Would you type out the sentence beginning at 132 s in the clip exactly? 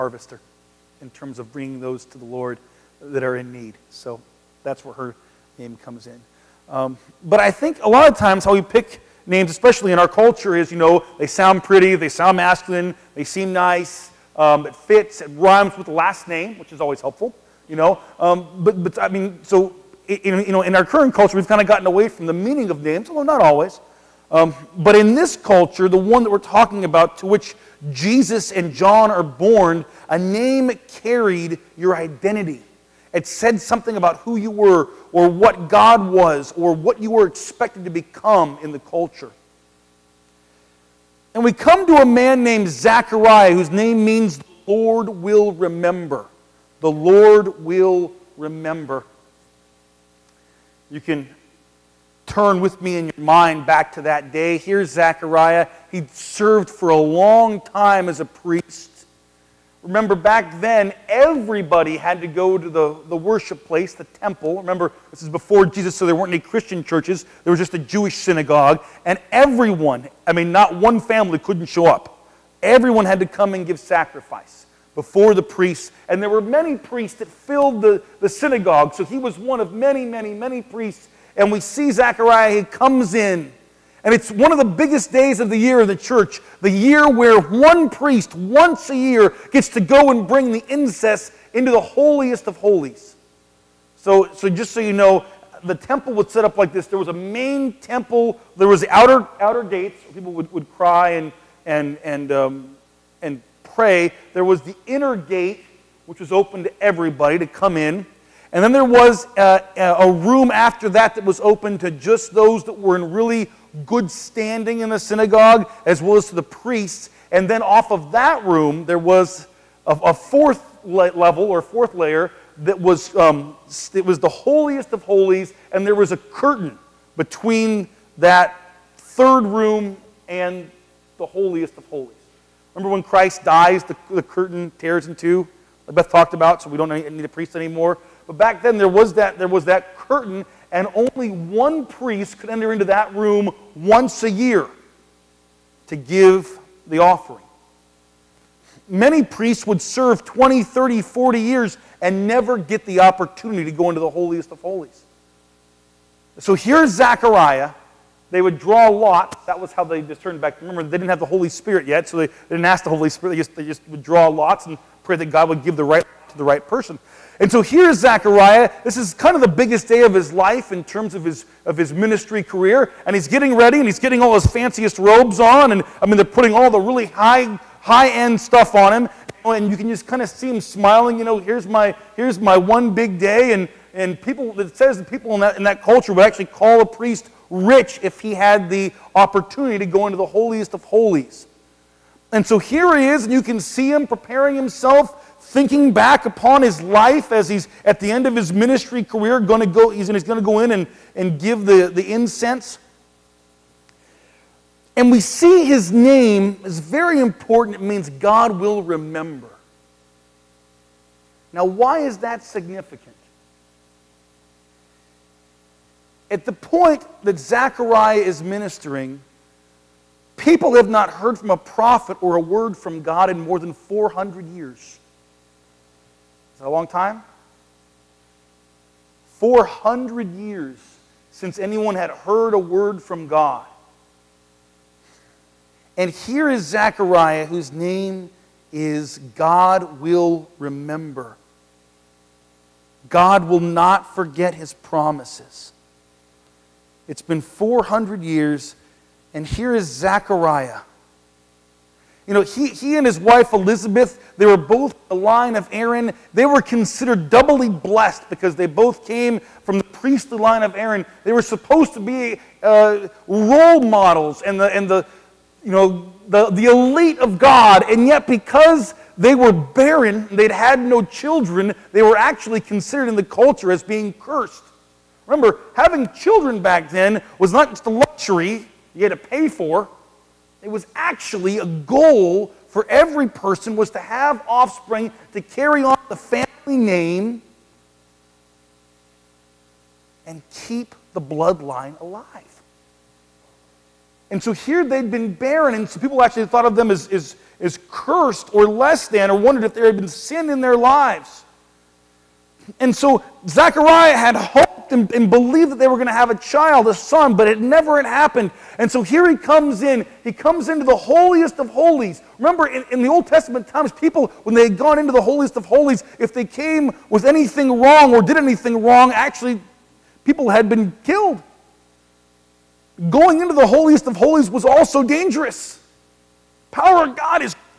Remember when Christ dies, the, the curtain tears in two?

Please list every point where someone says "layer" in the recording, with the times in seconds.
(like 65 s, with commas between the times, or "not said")
121 s.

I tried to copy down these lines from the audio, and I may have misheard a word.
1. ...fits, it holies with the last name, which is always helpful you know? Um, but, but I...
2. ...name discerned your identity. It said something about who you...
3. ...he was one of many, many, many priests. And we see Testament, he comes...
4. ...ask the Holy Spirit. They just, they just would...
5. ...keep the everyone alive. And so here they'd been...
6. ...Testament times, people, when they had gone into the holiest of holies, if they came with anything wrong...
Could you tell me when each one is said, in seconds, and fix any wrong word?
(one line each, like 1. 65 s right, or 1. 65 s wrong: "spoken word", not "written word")
1. 14 s wrong: "rhymes", not "holies"
2. 30 s wrong: "carried", not "discerned"
3. 79 s wrong: "Zechariah", not "Testament"
4. 162 s right
5. 290 s wrong: "bloodline", not "everyone"
6. 313 s right.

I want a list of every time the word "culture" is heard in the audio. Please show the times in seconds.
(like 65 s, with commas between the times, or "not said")
10 s, 21 s, 25 s, 38 s, 185 s, 273 s.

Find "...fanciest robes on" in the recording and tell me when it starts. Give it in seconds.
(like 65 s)
174 s.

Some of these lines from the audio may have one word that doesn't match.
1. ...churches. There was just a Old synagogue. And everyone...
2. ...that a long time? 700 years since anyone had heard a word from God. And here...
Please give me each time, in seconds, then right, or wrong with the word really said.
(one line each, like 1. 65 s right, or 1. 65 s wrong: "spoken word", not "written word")
1. 66 s wrong: "Jewish", not "Old"
2. 226 s wrong: "400", not "700".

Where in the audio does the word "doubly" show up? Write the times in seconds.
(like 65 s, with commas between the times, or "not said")
257 s.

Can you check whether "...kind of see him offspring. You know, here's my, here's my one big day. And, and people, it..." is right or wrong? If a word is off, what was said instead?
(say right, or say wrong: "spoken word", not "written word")
wrong: "smiling", not "offspring".